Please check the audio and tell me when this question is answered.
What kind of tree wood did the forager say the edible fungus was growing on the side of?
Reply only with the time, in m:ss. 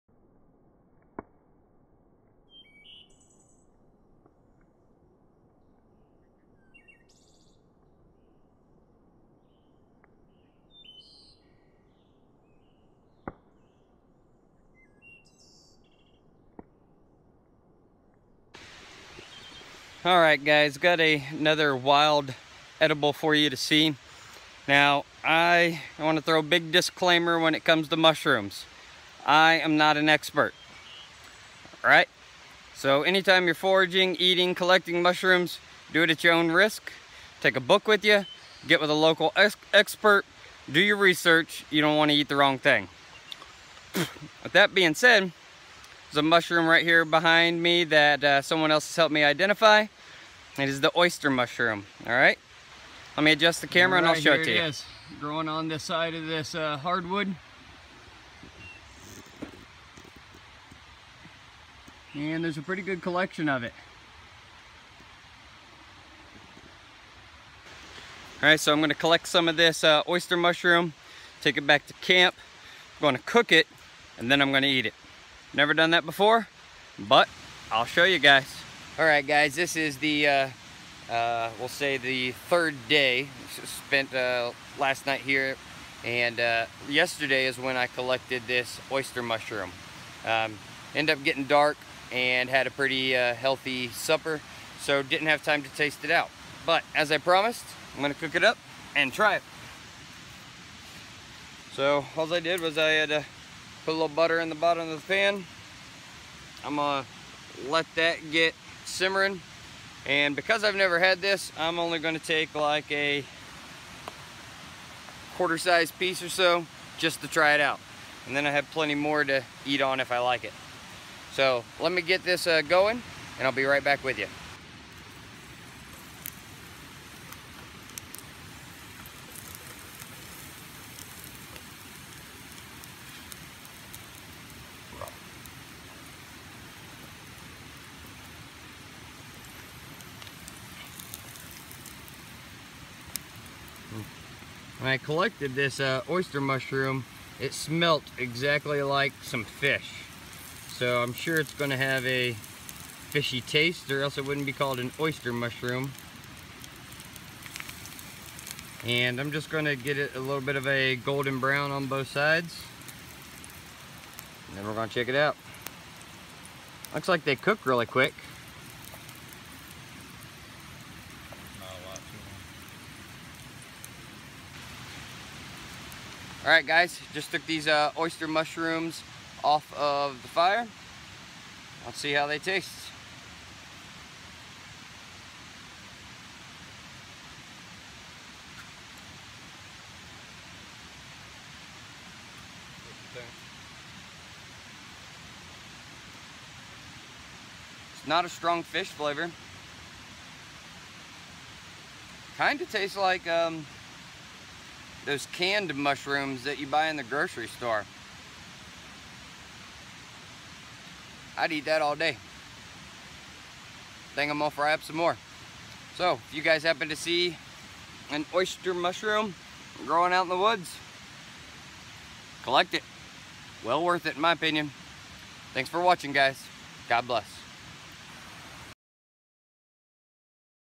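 0:56.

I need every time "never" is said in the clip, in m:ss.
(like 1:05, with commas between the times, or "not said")
1:15, 1:50.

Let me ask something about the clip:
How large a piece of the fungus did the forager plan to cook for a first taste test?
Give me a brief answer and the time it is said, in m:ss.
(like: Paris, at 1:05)
quarter size, at 1:55.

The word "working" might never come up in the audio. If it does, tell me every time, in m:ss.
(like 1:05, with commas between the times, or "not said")
not said.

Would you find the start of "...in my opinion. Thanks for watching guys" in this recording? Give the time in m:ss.
3:44.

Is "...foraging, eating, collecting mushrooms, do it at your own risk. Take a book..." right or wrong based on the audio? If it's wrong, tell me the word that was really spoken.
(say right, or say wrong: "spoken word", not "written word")
right.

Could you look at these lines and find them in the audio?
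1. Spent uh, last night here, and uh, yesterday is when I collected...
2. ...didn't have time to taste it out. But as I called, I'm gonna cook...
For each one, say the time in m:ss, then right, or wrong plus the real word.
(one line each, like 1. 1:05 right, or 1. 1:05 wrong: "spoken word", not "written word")
1. 1:23 right
2. 1:35 wrong: "promised", not "called".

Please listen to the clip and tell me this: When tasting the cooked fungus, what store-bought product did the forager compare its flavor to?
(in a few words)
canned mushrooms.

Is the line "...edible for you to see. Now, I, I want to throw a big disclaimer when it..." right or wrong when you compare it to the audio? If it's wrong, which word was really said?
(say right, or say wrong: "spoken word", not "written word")
right.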